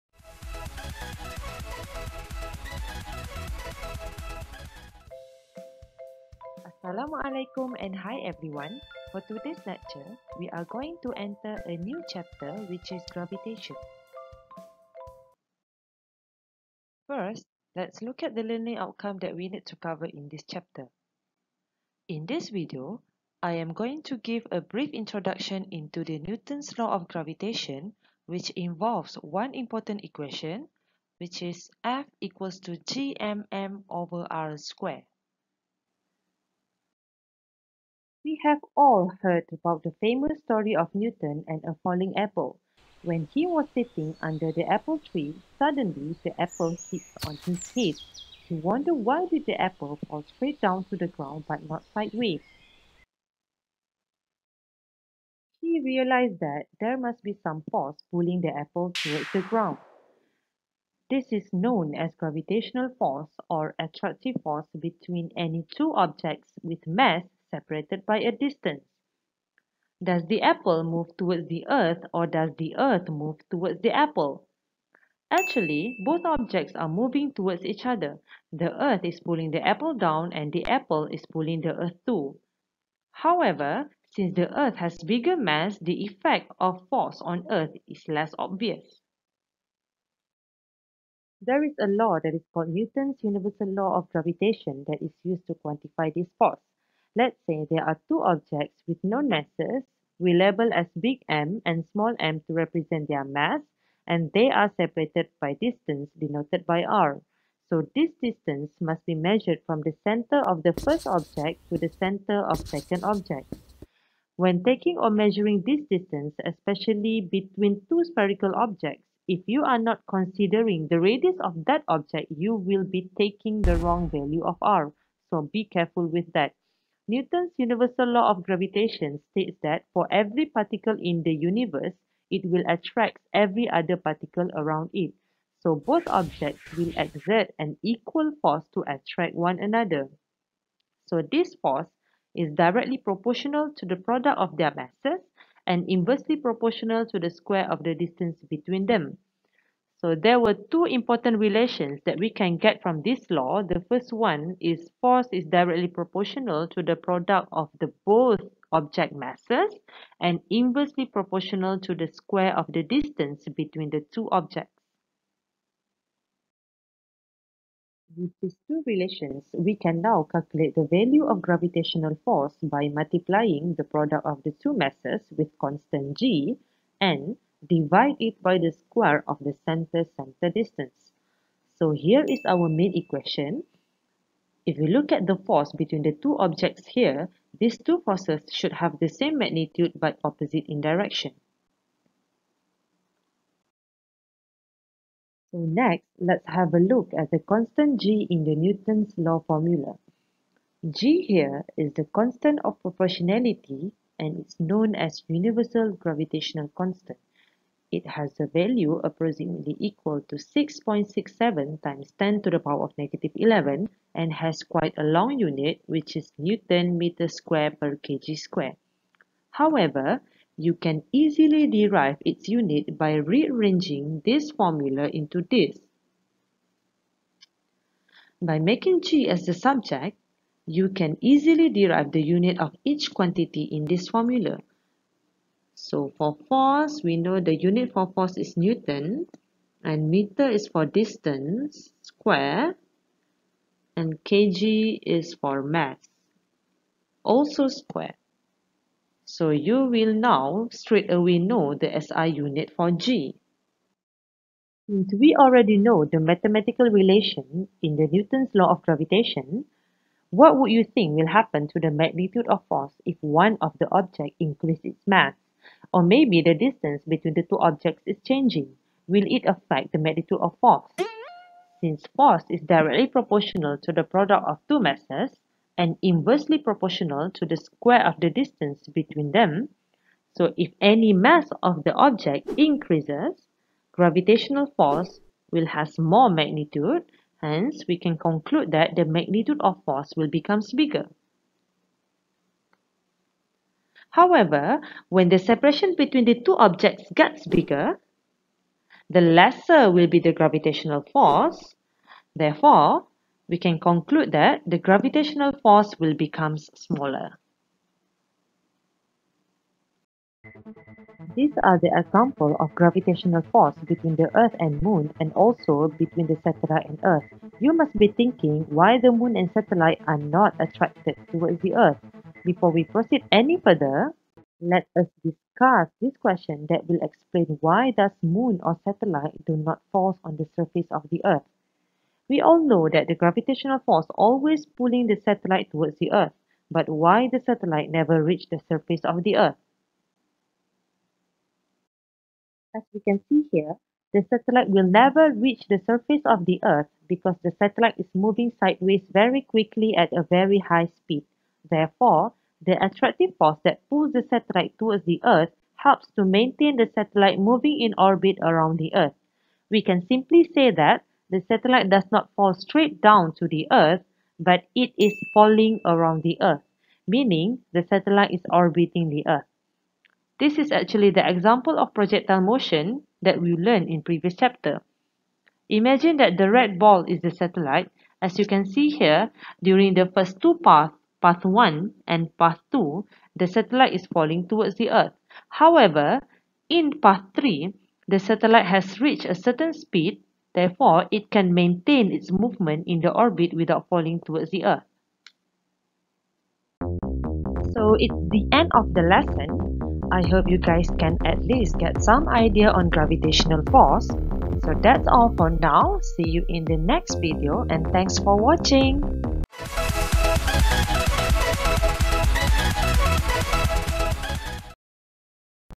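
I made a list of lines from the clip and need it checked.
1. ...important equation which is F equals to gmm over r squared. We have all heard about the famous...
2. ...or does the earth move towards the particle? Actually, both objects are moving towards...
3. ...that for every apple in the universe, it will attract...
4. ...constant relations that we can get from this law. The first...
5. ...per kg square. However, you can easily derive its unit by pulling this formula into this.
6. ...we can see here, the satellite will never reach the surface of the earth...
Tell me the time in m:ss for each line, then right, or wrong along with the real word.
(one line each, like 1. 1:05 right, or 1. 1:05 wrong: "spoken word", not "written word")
1. 0:29 right
2. 1:12 wrong: "apple", not "particle"
3. 2:09 wrong: "particle", not "apple"
4. 2:30 wrong: "important", not "constant"
5. 3:37 wrong: "rearranging", not "pulling"
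6. 5:42 right.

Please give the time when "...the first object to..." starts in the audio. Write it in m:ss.
1:50.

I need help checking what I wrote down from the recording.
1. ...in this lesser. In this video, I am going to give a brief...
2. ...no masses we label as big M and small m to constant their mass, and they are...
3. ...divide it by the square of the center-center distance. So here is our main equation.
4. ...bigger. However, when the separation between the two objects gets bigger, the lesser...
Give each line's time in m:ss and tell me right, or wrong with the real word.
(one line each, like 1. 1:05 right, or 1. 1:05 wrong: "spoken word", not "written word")
1. 0:20 wrong: "chapter", not "lesser"
2. 1:39 wrong: "represent", not "constant"
3. 2:57 right
4. 4:50 right.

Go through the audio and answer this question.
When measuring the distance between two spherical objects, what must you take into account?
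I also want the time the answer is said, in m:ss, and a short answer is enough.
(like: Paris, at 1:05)
the radius, at 2:01.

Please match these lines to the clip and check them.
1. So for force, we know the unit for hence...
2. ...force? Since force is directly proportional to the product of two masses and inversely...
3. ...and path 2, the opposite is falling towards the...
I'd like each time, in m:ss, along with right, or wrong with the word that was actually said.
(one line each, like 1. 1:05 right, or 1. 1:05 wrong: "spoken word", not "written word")
1. 3:55 wrong: "force", not "hence"
2. 4:30 right
3. 6:22 wrong: "satellite", not "opposite".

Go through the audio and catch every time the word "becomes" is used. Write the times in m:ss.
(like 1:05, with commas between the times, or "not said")
4:50, 5:06.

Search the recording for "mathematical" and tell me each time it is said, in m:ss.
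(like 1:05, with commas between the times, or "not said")
4:16.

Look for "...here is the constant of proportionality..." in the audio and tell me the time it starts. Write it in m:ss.
3:21.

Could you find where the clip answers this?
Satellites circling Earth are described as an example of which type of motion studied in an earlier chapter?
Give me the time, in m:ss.
6:11.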